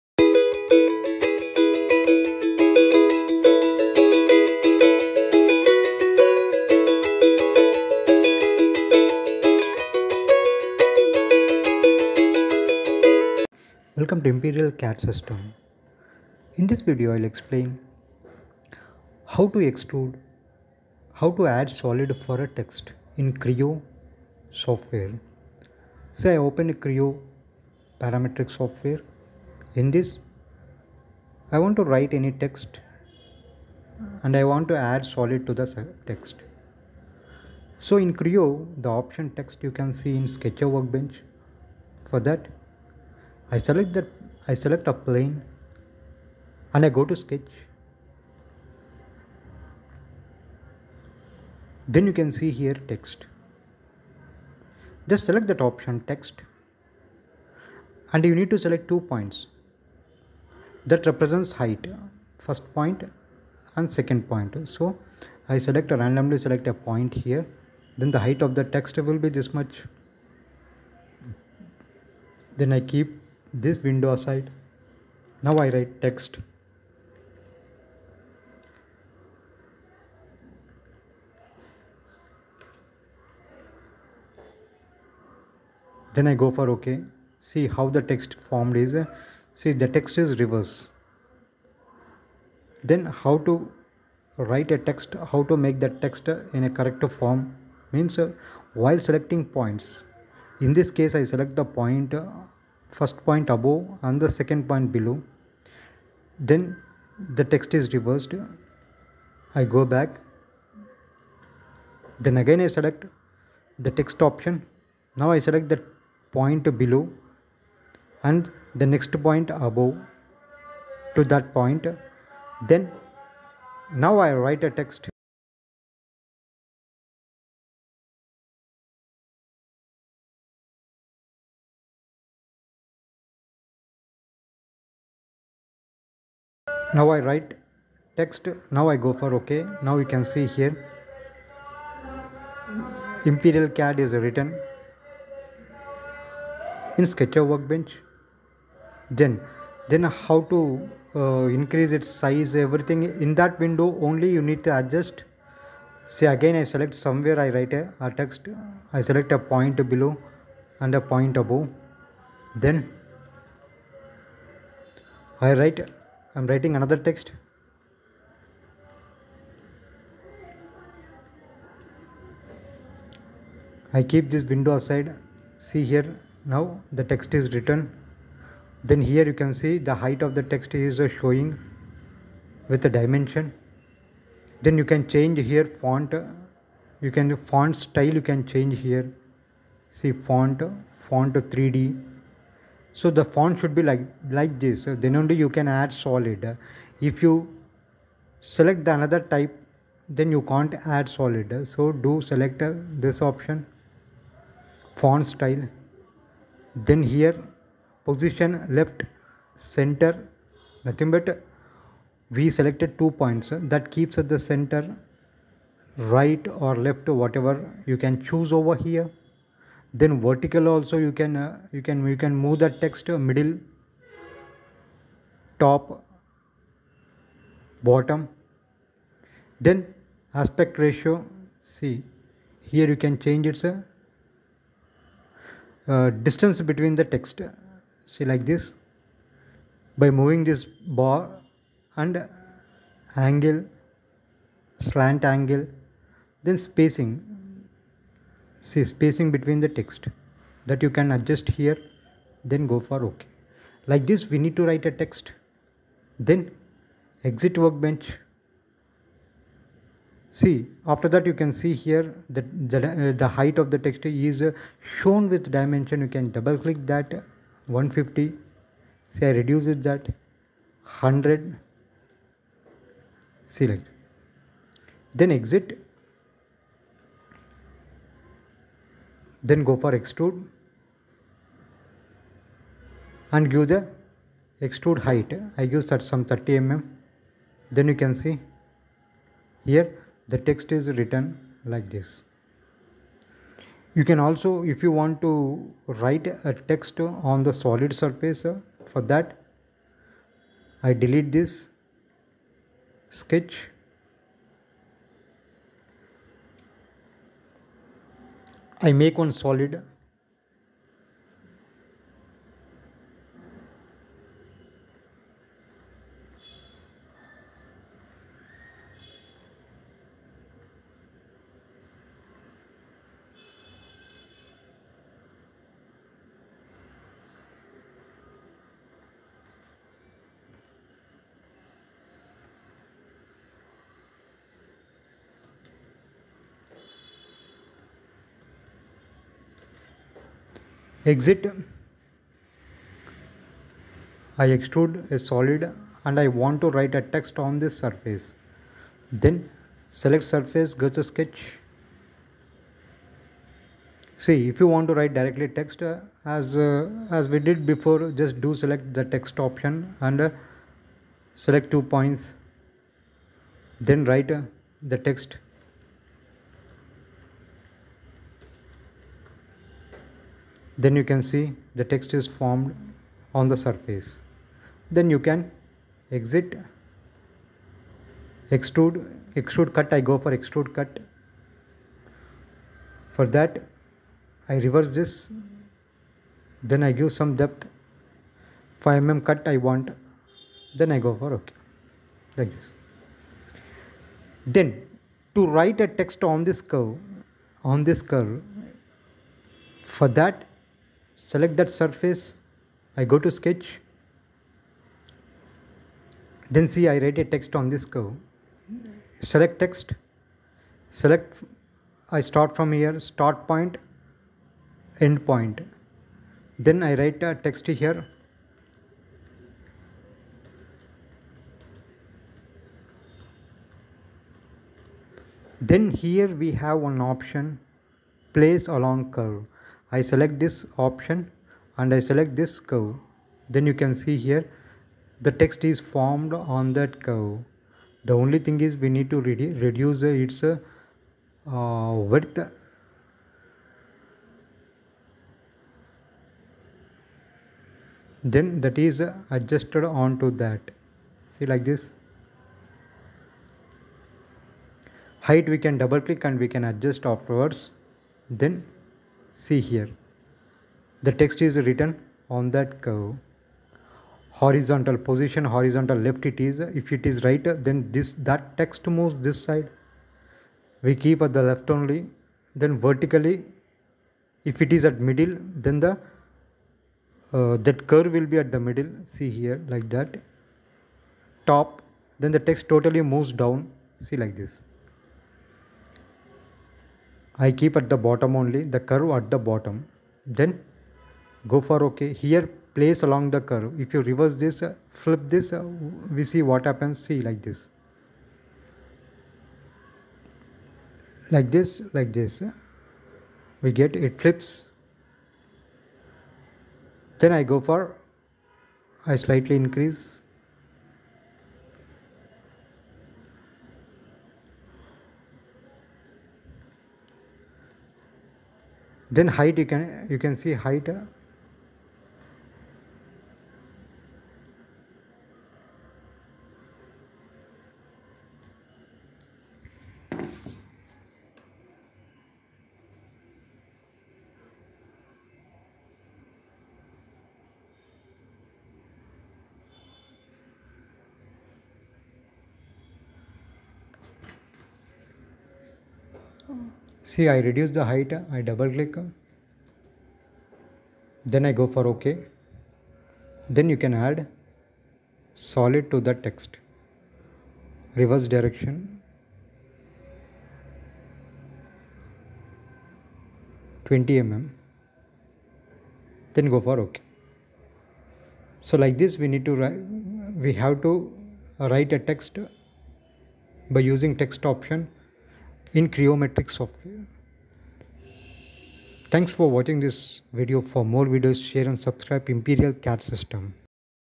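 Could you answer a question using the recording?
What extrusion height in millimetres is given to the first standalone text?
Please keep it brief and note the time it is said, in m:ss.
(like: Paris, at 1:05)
30 mm, at 4:46.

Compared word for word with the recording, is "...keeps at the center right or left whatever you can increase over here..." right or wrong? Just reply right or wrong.
wrong.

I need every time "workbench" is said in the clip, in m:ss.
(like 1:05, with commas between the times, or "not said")
0:40, 2:27, 4:17.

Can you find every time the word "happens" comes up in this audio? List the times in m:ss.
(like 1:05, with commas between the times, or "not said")
8:16.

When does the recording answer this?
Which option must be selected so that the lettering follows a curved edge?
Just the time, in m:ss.
7:08.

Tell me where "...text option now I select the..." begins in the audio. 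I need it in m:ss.
1:53.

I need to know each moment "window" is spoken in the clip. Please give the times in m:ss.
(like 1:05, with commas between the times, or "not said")
1:13, 2:33, 2:54.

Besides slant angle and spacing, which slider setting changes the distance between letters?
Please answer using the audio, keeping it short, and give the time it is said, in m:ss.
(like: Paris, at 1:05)
aspect ratio, at 3:50.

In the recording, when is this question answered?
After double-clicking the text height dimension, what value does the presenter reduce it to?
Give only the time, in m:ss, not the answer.
4:30.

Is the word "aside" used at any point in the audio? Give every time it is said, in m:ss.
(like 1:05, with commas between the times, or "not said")
1:14, 2:54.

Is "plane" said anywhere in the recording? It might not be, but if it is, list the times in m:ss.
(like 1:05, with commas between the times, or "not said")
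0:44.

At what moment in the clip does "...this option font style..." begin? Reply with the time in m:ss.
3:23.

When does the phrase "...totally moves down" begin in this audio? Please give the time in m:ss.
8:02.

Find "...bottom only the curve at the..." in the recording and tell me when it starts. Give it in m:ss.
8:07.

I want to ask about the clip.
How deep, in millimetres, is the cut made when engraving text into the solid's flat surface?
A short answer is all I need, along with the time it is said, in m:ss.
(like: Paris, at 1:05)
5 mm, at 6:28.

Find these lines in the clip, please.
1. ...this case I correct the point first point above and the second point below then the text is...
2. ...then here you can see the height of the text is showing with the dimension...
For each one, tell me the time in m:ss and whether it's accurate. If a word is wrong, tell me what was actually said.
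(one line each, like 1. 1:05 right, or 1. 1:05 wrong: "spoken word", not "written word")
1. 1:40 wrong: "select", not "correct"
2. 2:58 right.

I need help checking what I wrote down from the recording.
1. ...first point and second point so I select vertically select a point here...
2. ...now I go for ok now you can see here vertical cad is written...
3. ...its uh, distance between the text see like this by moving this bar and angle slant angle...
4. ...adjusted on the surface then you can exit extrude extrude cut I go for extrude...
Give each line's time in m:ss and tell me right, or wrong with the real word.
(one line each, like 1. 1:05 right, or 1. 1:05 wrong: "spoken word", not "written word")
1. 1:02 wrong: "randomly", not "vertically"
2. 2:18 wrong: "imperial", not "vertical"
3. 3:53 right
4. 6:12 wrong: "formed", not "adjusted".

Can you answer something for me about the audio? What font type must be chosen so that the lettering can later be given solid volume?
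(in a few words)
font 3d.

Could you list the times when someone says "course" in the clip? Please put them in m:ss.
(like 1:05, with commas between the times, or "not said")
not said.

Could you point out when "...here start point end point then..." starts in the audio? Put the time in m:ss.
6:52.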